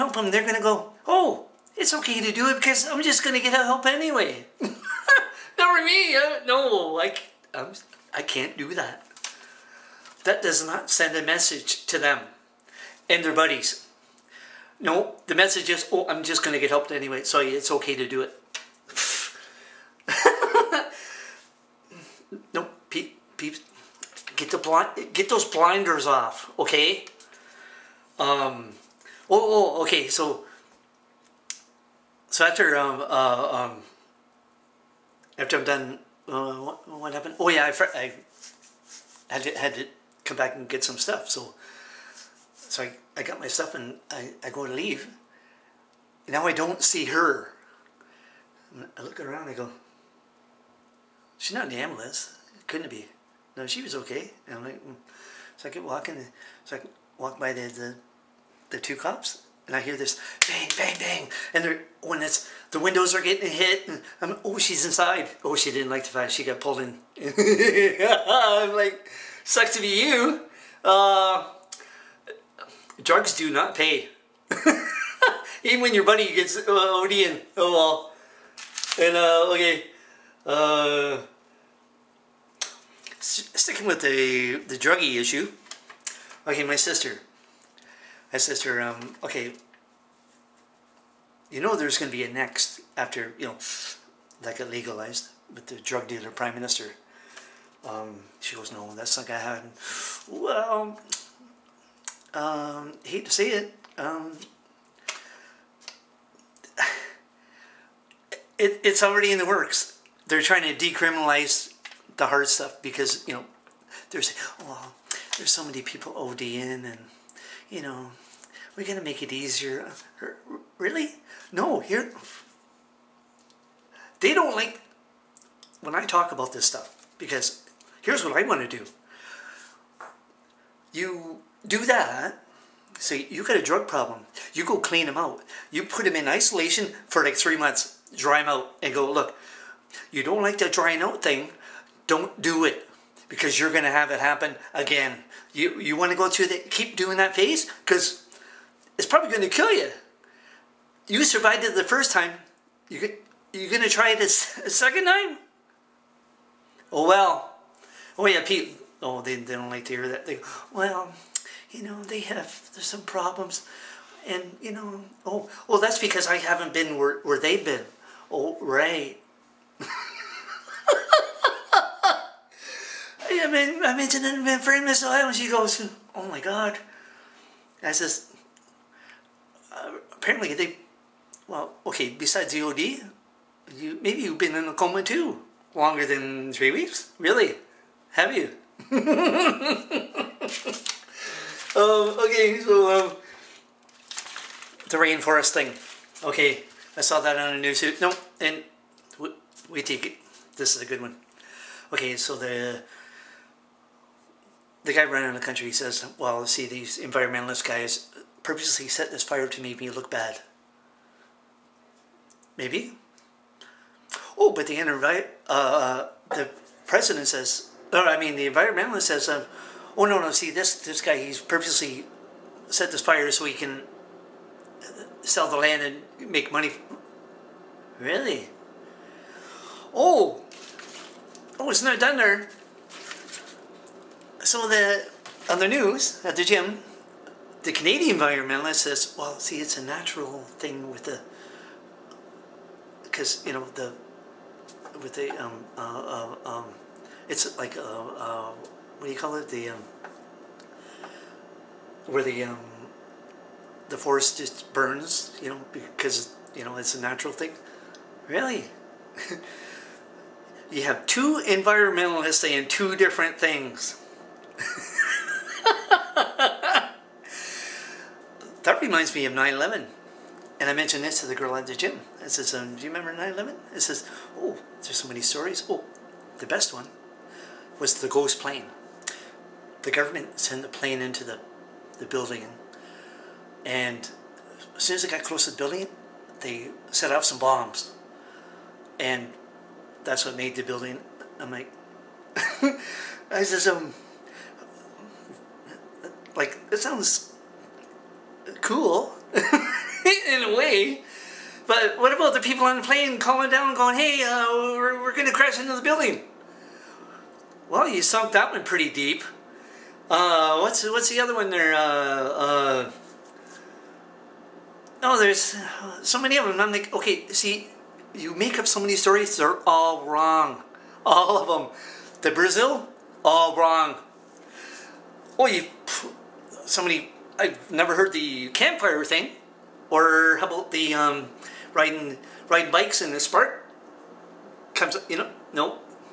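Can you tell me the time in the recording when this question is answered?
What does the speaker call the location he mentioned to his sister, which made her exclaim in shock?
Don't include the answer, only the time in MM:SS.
02:54.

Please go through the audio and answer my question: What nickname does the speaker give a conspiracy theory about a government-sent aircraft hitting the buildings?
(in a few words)
ghost plane.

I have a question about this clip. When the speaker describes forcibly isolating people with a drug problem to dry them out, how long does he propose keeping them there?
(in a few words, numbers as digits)
3 months.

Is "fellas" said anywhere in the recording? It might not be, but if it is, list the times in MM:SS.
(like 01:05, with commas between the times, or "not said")
not said.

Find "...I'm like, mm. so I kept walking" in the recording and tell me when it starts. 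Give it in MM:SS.
00:54.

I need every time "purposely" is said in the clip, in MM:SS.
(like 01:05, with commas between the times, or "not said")
03:28, 03:41.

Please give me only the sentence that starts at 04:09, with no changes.
The, um, where the, um, the forest just burns, you know, because, you know, it's a natural thing.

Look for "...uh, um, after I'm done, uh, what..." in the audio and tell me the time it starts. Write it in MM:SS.
00:33.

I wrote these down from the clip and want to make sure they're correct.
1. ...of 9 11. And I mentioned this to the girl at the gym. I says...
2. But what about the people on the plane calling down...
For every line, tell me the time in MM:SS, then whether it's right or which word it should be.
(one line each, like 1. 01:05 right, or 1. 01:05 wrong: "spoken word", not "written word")
1. 04:29 right
2. 05:01 right.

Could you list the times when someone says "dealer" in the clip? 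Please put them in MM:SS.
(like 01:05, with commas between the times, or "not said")
01:36.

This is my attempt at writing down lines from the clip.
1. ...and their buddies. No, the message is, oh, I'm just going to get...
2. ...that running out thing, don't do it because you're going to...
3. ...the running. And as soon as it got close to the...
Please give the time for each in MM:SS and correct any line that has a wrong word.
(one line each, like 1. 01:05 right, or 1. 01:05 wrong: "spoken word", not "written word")
1. 00:13 right
2. 02:20 wrong: "drying", not "running"
3. 04:41 wrong: "building", not "running".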